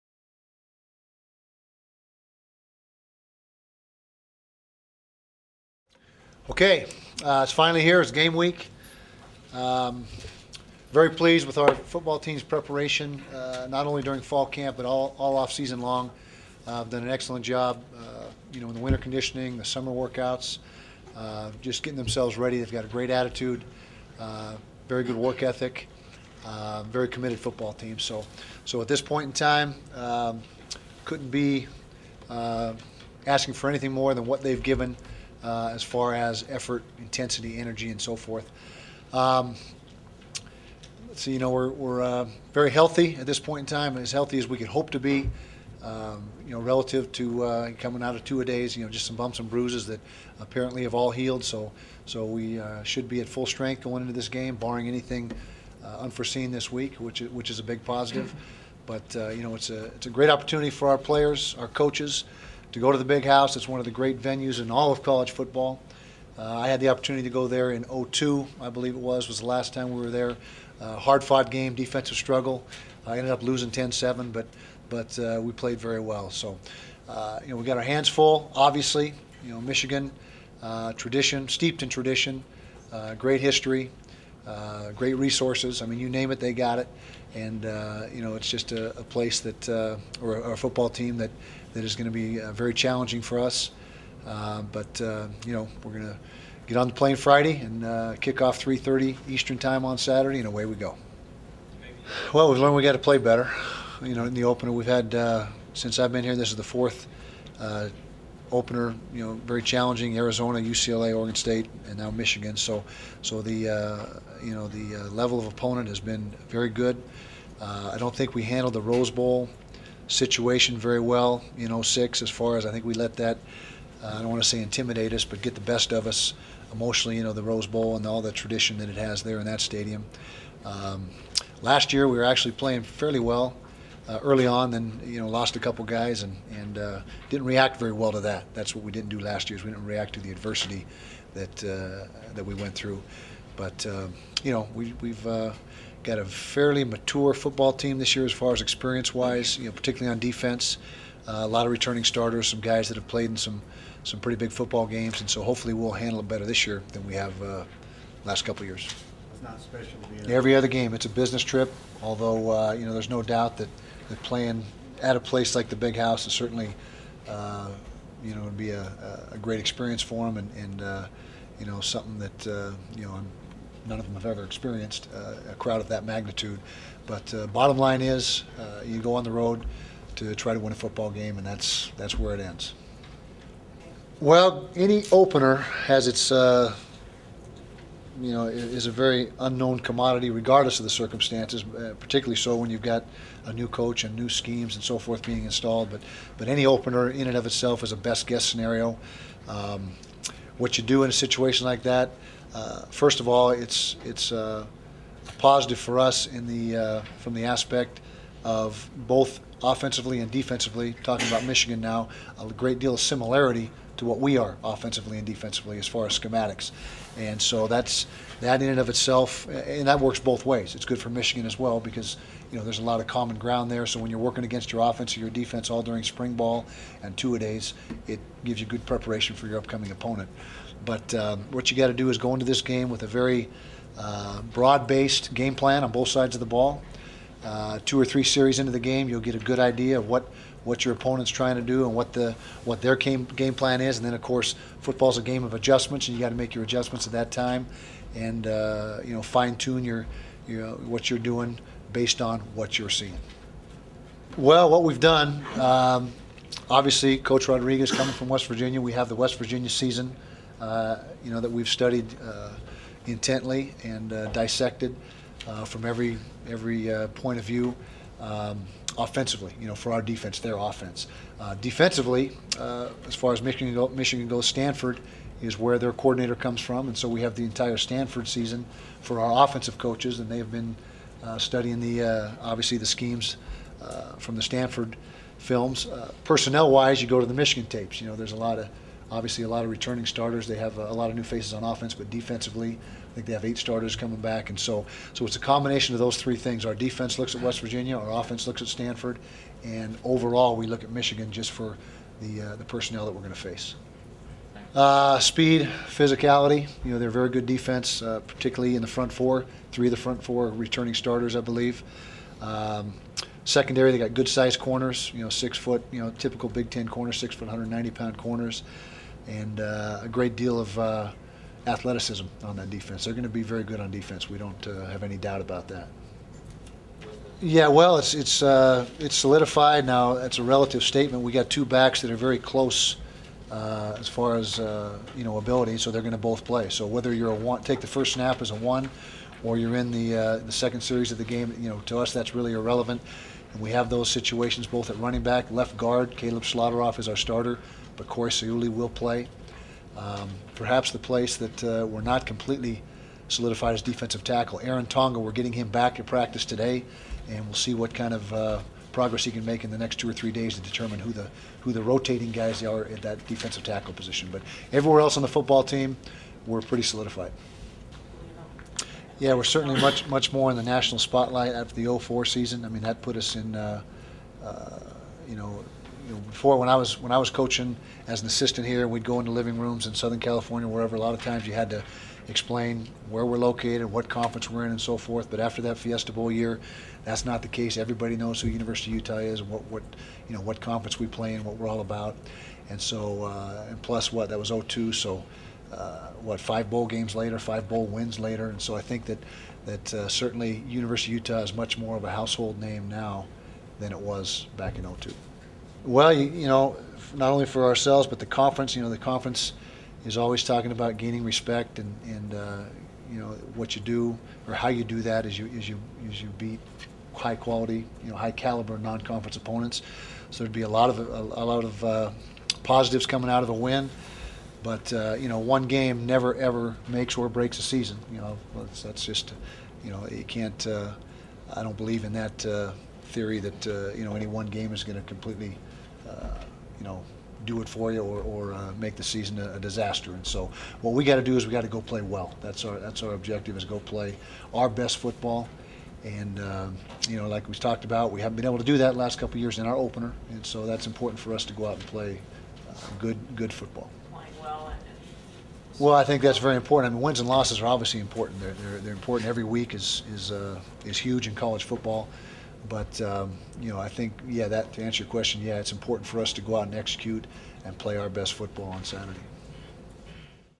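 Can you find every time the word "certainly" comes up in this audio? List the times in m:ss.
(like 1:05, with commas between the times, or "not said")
2:46, 6:09, 6:40.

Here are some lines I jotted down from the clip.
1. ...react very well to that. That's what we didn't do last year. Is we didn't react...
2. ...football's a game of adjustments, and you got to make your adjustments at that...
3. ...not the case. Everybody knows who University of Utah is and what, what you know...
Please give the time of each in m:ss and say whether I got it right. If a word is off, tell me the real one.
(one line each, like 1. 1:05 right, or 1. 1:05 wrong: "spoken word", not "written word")
1. 2:17 right
2. 4:04 right
3. 6:27 right.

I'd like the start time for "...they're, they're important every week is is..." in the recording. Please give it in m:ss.
7:38.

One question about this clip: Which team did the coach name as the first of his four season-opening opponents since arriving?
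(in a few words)
Arizona.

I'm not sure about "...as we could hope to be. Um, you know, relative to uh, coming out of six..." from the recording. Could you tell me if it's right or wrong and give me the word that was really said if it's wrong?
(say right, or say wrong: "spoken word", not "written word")
wrong: "two", not "six".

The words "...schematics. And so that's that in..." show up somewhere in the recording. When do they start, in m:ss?
3:36.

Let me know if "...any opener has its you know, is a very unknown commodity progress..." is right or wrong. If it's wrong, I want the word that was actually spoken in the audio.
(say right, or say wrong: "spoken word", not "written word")
wrong: "regardless", not "progress".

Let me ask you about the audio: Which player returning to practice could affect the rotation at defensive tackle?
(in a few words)
Aaron Tonga.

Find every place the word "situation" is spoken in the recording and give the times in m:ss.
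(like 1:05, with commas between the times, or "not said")
2:00, 3:21, 5:44.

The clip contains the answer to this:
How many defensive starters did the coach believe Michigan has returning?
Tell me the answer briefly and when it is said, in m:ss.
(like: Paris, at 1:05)
8, at 4:53.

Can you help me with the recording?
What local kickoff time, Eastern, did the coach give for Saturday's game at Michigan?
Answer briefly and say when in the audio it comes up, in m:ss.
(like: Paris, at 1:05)
3:30, at 1:38.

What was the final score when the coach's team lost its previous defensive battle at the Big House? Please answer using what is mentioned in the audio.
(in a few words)
10-7.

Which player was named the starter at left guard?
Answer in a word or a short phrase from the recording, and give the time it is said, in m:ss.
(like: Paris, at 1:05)
Caleb Schlauderaff, at 5:46.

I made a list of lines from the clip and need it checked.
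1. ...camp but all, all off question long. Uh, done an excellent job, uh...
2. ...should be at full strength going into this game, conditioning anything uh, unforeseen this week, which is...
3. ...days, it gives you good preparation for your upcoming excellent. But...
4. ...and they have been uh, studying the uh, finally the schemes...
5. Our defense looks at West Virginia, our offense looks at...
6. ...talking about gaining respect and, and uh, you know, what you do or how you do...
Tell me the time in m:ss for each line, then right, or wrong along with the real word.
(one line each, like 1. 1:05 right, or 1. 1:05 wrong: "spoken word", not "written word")
1. 0:14 wrong: "season", not "question"
2. 0:52 wrong: "barring", not "conditioning"
3. 3:47 wrong: "opponent", not "excellent"
4. 4:40 wrong: "obviously", not "finally"
5. 4:56 right
6. 6:50 right.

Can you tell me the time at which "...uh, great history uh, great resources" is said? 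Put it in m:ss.
1:22.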